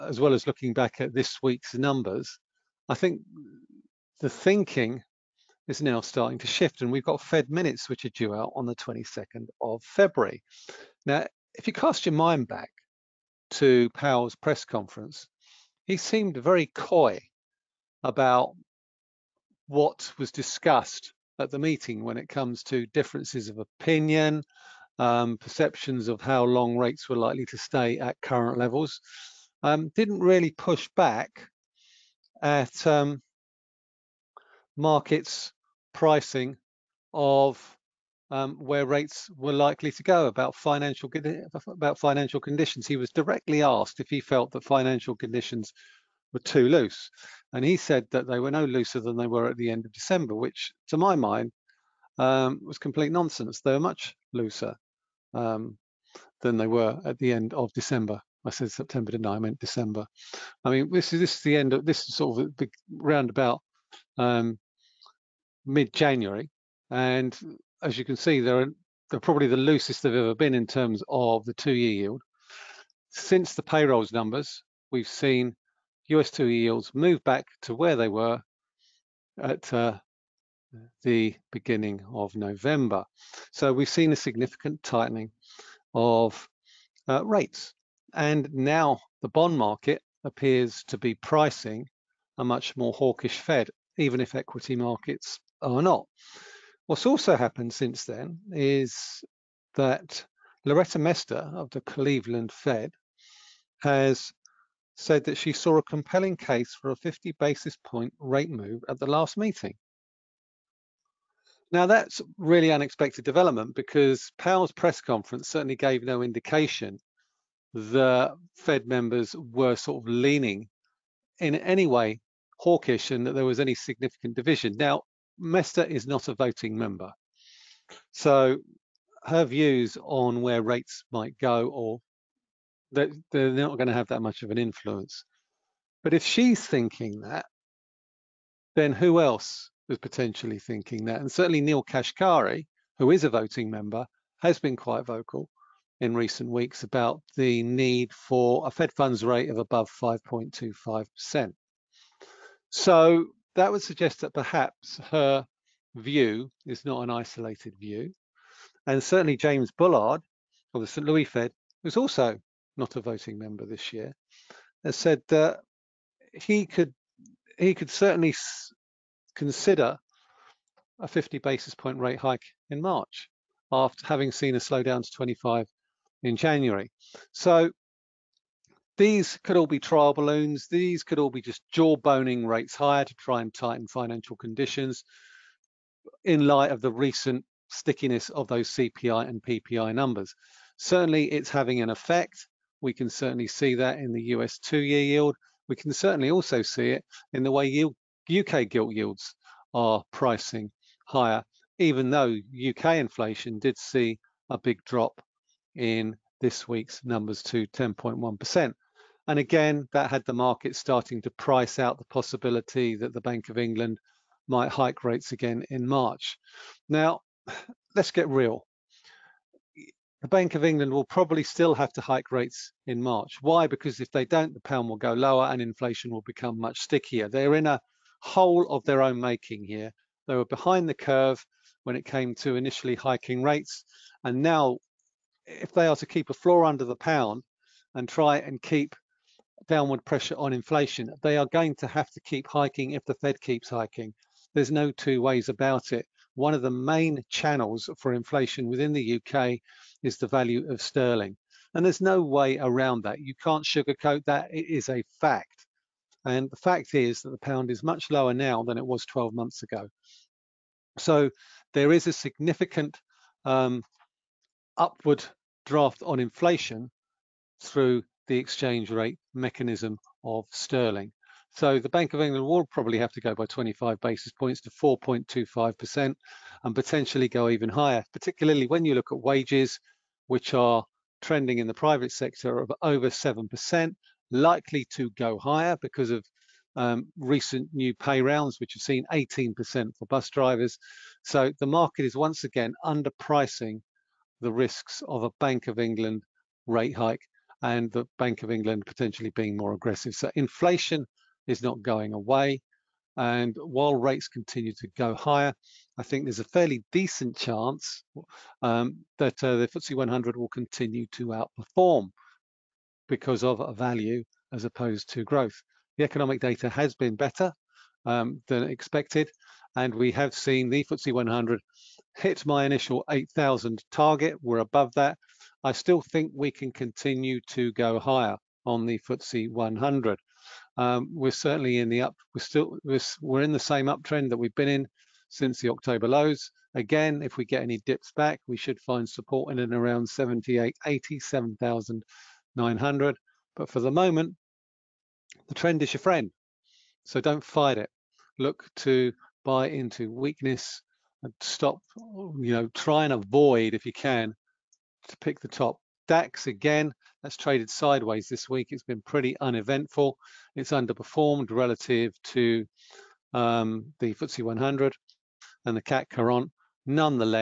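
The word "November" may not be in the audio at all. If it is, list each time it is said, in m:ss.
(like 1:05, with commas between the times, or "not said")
1:22.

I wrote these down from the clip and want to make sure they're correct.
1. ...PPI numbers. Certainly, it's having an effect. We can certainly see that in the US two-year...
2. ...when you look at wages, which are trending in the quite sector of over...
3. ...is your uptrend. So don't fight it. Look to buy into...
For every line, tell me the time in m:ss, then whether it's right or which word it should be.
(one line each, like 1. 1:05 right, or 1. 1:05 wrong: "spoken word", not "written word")
1. 3:09 right
2. 4:38 wrong: "private", not "quite"
3. 5:45 wrong: "friend", not "uptrend".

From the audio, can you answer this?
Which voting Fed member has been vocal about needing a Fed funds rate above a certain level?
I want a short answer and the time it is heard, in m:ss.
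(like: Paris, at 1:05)
Neel Kashkari, at 2:21.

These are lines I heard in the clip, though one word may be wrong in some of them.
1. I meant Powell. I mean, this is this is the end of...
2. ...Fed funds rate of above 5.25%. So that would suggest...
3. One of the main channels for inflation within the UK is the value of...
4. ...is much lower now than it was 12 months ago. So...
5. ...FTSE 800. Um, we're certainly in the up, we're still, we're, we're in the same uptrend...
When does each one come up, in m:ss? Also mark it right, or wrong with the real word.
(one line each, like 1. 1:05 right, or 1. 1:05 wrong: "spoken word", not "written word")
1. 0:59 wrong: "December", not "Powell"
2. 2:28 right
3. 4:06 right
4. 4:17 right
5. 5:28 wrong: "100", not "800".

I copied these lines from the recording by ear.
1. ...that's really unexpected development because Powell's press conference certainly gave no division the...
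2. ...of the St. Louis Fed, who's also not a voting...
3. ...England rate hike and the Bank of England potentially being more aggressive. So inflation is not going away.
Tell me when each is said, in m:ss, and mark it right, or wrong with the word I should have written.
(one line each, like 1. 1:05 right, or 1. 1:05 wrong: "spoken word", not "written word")
1. 1:51 wrong: "indication", not "division"
2. 2:40 right
3. 4:55 right.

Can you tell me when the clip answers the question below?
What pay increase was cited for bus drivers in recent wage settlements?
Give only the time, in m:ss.
4:49.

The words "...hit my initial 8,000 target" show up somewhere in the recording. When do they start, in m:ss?
5:22.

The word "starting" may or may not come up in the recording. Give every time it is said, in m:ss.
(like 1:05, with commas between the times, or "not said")
0:06, 3:30.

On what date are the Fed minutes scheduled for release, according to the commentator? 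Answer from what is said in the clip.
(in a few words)
22nd of February.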